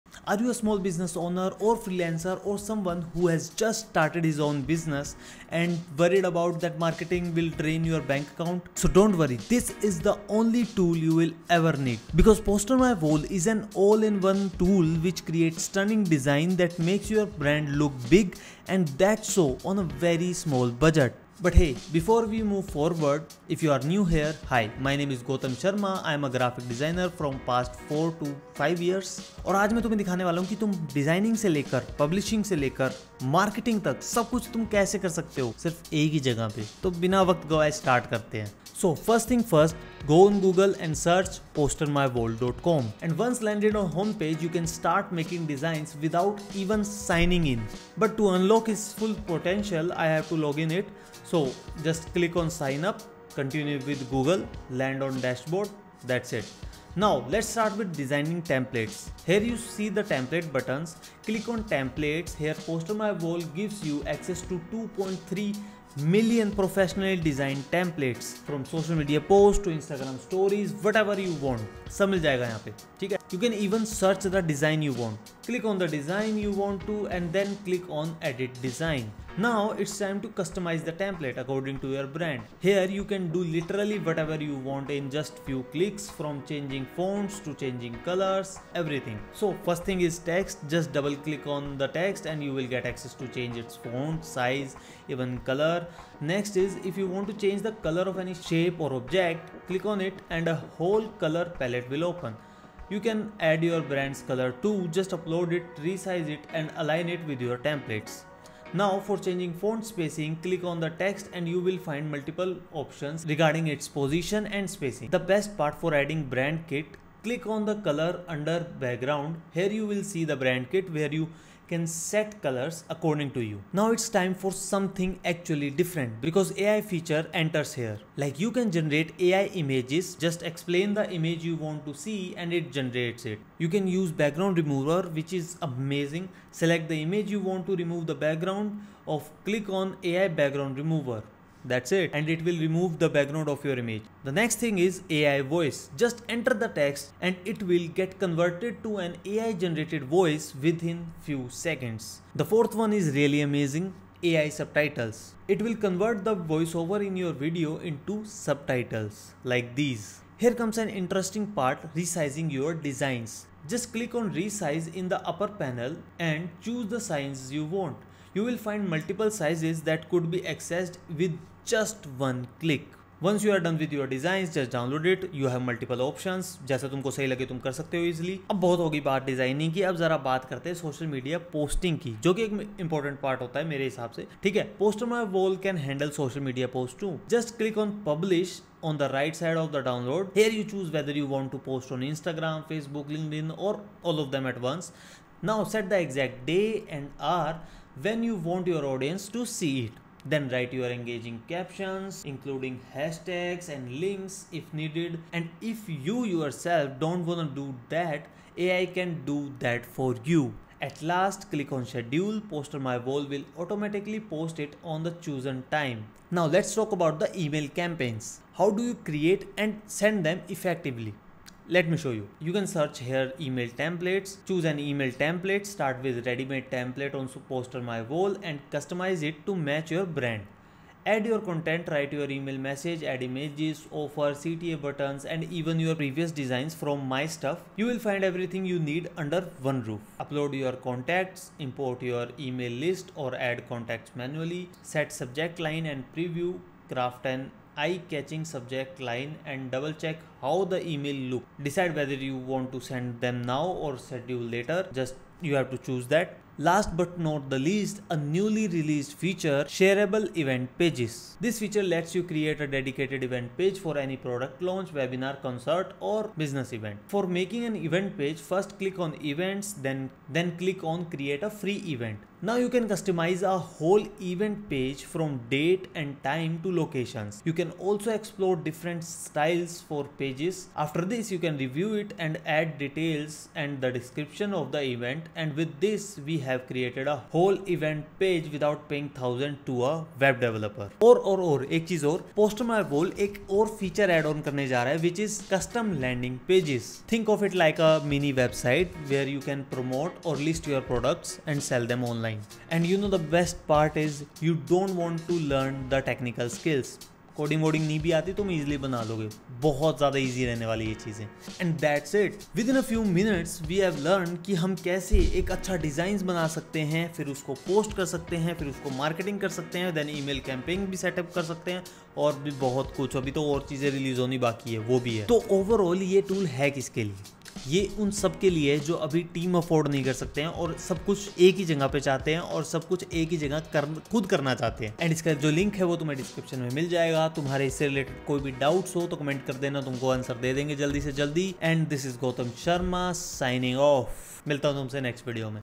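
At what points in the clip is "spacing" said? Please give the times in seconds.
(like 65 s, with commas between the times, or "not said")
109 s, 114 s.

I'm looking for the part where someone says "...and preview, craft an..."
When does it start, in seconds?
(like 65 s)
245 s.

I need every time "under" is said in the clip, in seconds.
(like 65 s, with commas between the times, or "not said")
118 s, 239 s.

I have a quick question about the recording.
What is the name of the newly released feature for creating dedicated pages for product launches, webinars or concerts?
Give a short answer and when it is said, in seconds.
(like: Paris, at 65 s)
Shareable event pages, at 259 s.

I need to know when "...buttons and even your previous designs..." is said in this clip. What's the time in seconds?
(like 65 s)
234 s.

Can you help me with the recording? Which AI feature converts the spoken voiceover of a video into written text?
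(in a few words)
AI subtitles.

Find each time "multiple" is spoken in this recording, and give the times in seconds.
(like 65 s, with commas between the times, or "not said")
112 s, 168 s, 175 s.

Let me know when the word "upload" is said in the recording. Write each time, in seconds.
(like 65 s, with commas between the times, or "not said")
105 s, 240 s.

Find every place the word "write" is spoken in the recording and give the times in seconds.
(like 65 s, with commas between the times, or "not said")
200 s, 231 s.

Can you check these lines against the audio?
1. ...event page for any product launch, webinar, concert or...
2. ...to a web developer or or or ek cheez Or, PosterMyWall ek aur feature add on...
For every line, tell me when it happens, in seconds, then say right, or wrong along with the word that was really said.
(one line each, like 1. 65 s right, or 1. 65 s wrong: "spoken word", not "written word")
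1. 263 s right
2. 289 s right.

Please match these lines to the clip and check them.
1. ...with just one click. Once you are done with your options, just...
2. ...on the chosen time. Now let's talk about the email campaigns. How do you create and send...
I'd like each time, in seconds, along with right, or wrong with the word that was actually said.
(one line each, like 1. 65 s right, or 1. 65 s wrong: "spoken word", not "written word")
1. 171 s wrong: "designs", not "options"
2. 214 s right.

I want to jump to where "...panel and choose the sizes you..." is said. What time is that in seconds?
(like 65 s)
165 s.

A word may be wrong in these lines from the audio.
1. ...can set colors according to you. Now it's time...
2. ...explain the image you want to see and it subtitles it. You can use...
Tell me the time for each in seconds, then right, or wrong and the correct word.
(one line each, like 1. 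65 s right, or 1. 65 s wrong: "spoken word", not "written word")
1. 121 s right
2. 130 s wrong: "generates", not "subtitles".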